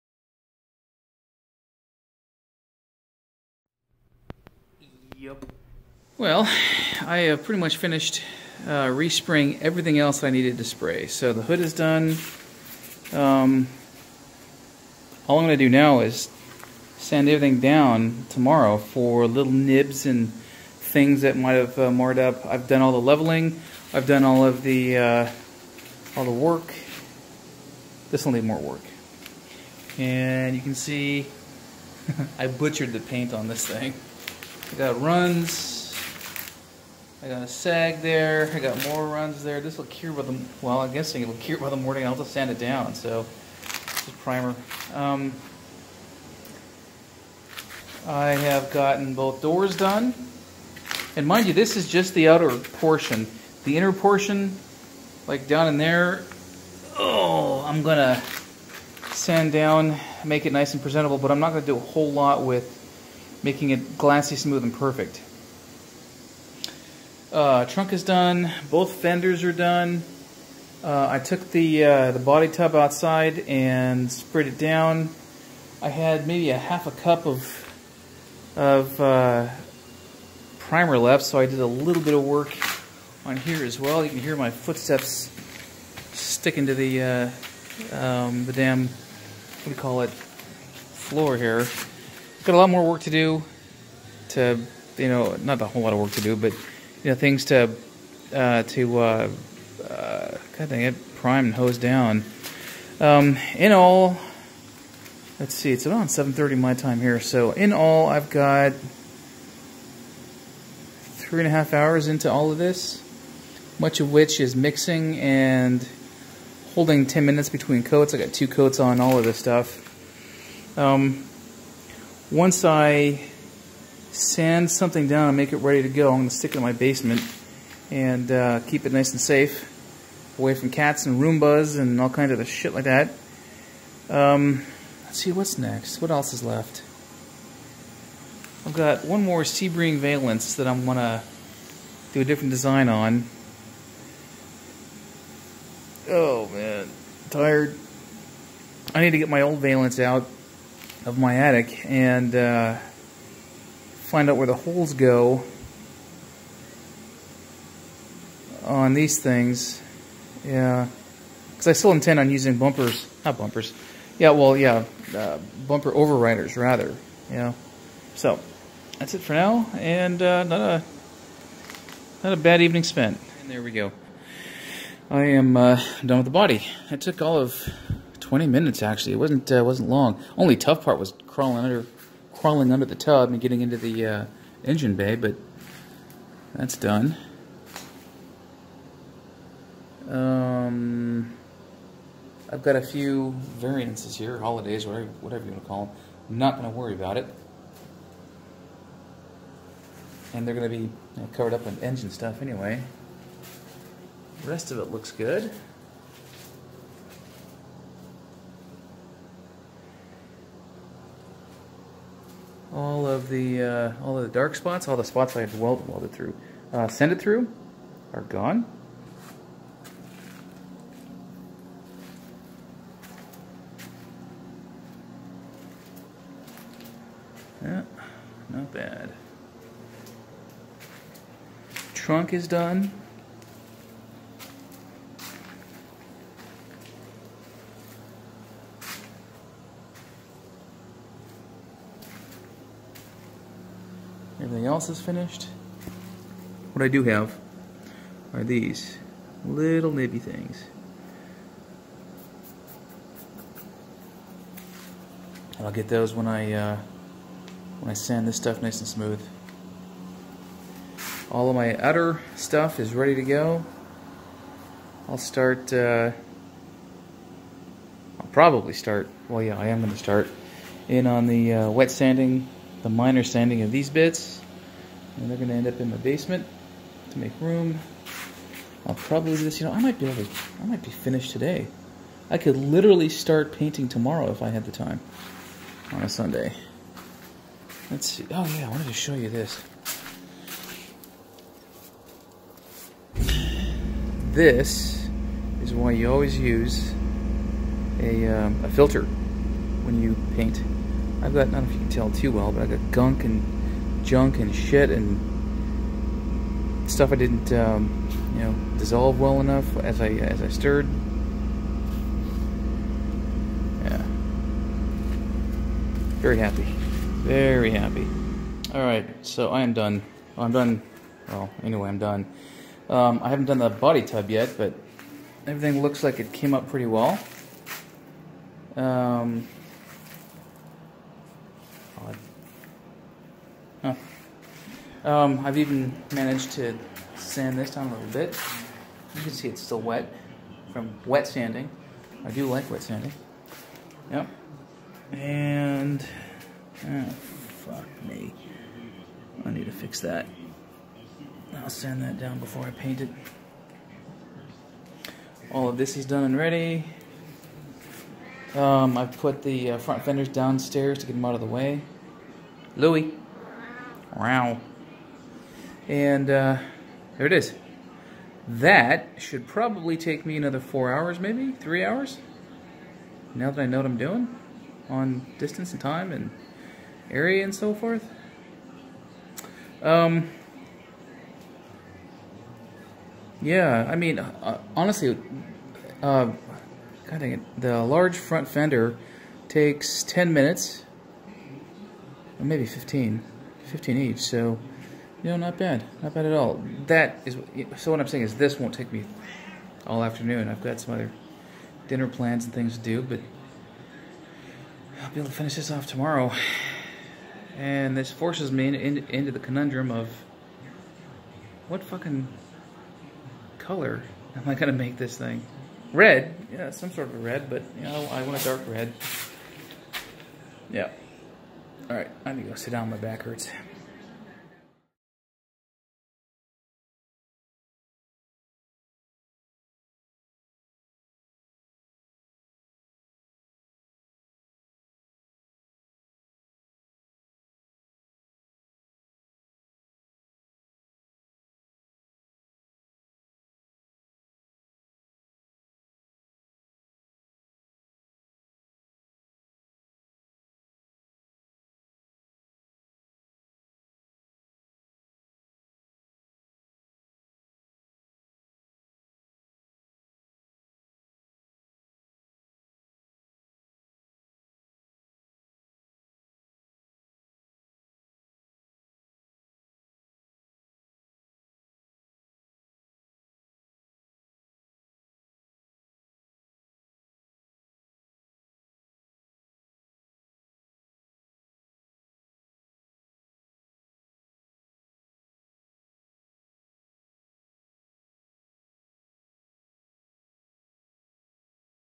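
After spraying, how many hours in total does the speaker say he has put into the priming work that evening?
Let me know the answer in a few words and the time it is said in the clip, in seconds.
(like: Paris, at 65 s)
3.5 hours, at 111 s.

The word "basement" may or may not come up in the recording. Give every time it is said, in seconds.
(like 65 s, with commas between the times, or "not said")
126 s, 275 s.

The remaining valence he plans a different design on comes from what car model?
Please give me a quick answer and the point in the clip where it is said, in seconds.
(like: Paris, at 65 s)
Sebring, at 139 s.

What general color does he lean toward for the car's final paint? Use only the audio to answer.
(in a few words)
dark red.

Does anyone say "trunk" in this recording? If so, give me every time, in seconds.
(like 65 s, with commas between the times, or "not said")
67 s, 231 s.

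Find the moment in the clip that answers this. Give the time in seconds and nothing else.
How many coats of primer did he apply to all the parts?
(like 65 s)
118 s.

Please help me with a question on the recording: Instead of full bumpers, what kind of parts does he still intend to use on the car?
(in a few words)
bumper overriders.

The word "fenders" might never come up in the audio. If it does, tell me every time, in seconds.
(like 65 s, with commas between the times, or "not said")
68 s, 360 s, 388 s.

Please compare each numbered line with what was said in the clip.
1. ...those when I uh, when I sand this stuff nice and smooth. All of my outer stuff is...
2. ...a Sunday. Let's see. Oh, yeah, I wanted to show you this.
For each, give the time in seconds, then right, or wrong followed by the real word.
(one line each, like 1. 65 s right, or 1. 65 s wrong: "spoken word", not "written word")
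1. 255 s right
2. 286 s right.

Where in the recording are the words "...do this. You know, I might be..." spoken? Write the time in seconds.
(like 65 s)
279 s.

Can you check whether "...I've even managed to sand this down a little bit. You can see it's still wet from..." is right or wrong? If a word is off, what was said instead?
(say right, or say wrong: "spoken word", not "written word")
right.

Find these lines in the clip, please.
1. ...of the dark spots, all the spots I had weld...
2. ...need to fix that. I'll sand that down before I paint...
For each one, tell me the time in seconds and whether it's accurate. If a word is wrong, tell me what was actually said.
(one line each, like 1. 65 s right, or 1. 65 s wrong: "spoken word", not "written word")
1. 214 s right
2. 349 s right.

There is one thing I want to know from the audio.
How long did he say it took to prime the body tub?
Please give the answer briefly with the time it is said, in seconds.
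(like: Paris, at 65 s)
20 minutes, at 178 s.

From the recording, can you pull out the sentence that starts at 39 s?
This will cure by the, well, I'm guessing it'll cure by the morning.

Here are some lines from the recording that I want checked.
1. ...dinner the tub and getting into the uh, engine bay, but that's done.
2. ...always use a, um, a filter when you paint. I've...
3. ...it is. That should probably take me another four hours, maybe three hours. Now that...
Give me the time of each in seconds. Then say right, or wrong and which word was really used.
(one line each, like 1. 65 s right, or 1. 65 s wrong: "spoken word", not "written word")
1. 182 s wrong: "under", not "dinner"
2. 296 s right
3. 367 s right.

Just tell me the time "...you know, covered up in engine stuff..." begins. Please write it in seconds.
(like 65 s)
200 s.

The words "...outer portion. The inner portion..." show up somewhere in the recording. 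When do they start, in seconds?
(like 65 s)
52 s.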